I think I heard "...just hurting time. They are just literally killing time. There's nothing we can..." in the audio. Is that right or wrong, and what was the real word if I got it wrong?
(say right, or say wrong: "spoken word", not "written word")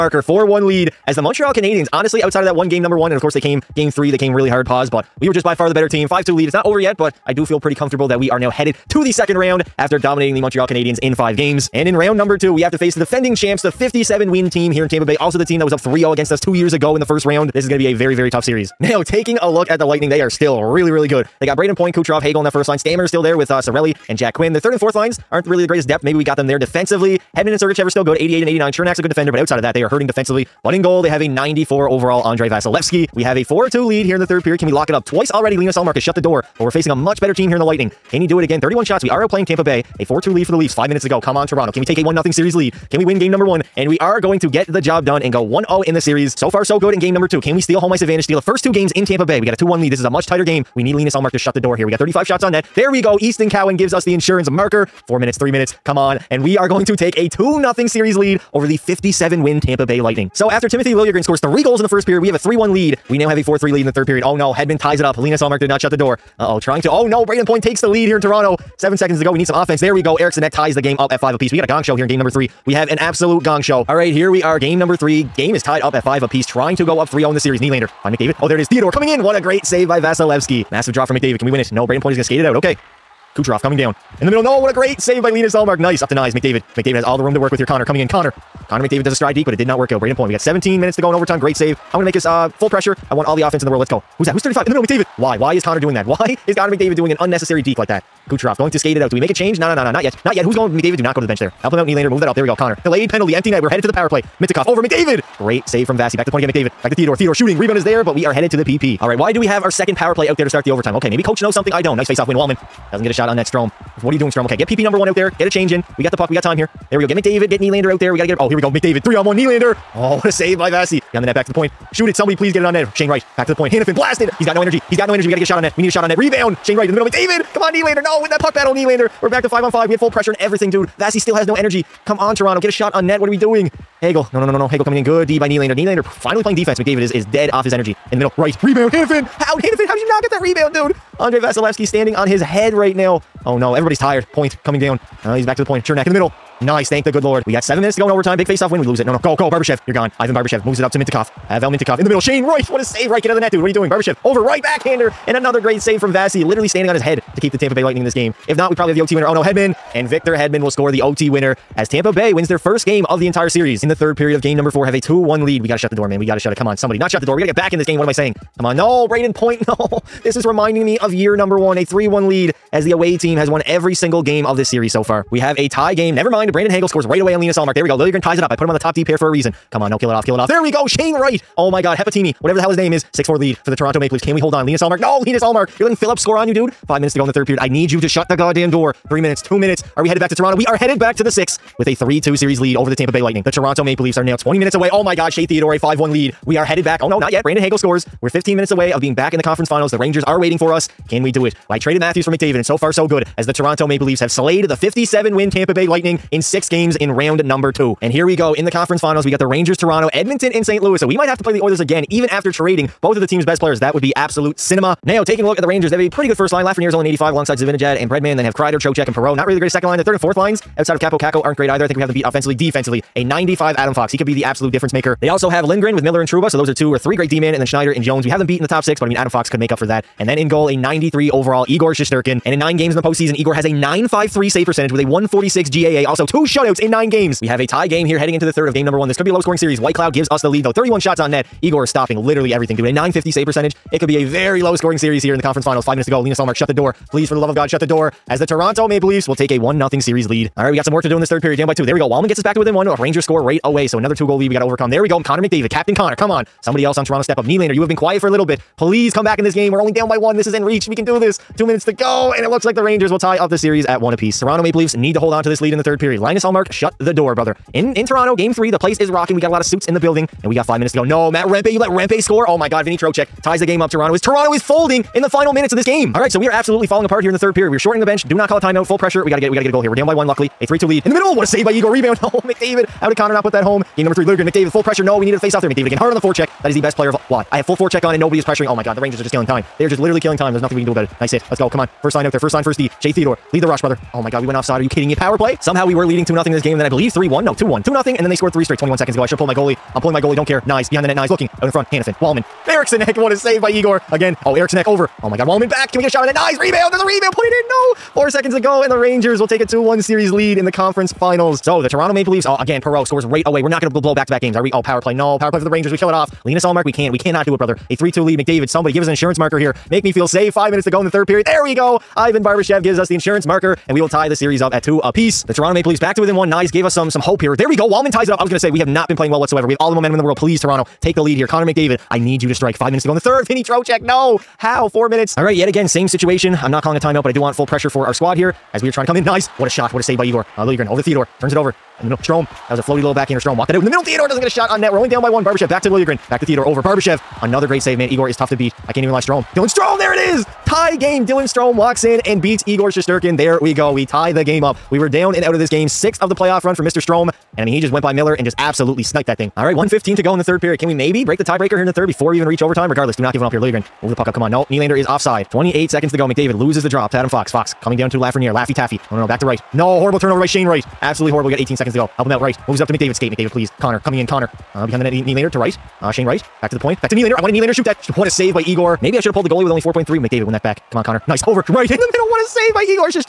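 wrong: "killing", not "hurting".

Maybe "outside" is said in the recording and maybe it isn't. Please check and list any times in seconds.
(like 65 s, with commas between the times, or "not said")
2 s, 29 s, 220 s.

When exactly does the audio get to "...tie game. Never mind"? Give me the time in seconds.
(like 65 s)
175 s.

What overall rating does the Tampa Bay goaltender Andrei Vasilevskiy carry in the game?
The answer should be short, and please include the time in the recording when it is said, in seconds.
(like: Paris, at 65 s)
94, at 31 s.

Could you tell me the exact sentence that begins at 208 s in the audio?
And here we go in the conference finals.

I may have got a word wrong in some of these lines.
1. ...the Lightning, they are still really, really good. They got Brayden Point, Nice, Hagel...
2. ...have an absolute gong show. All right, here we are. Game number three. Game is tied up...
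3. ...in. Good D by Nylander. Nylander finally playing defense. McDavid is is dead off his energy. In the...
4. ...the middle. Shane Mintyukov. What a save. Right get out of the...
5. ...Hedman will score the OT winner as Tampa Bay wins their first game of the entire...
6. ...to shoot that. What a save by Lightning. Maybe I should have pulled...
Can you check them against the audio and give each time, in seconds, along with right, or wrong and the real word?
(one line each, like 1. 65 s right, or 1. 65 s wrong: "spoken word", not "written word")
1. 19 s wrong: "Kucherov", not "Nice"
2. 72 s right
3. 134 s right
4. 152 s wrong: "Wright", not "Mintyukov"
5. 160 s right
6. 377 s wrong: "Igor", not "Lightning".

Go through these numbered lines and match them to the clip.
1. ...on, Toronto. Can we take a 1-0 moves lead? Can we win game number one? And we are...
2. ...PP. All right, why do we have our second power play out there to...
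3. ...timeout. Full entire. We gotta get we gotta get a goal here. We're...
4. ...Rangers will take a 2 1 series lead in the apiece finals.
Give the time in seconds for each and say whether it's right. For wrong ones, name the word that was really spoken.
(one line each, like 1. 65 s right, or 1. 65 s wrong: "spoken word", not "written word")
1. 41 s wrong: "series", not "moves"
2. 108 s right
3. 278 s wrong: "pressure", not "entire"
4. 308 s wrong: "conference", not "apiece".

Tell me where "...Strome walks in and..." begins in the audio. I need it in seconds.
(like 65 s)
351 s.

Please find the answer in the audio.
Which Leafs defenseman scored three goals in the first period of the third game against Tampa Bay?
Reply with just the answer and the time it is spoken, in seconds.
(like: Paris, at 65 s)
Timothy Liljegren, at 60 s.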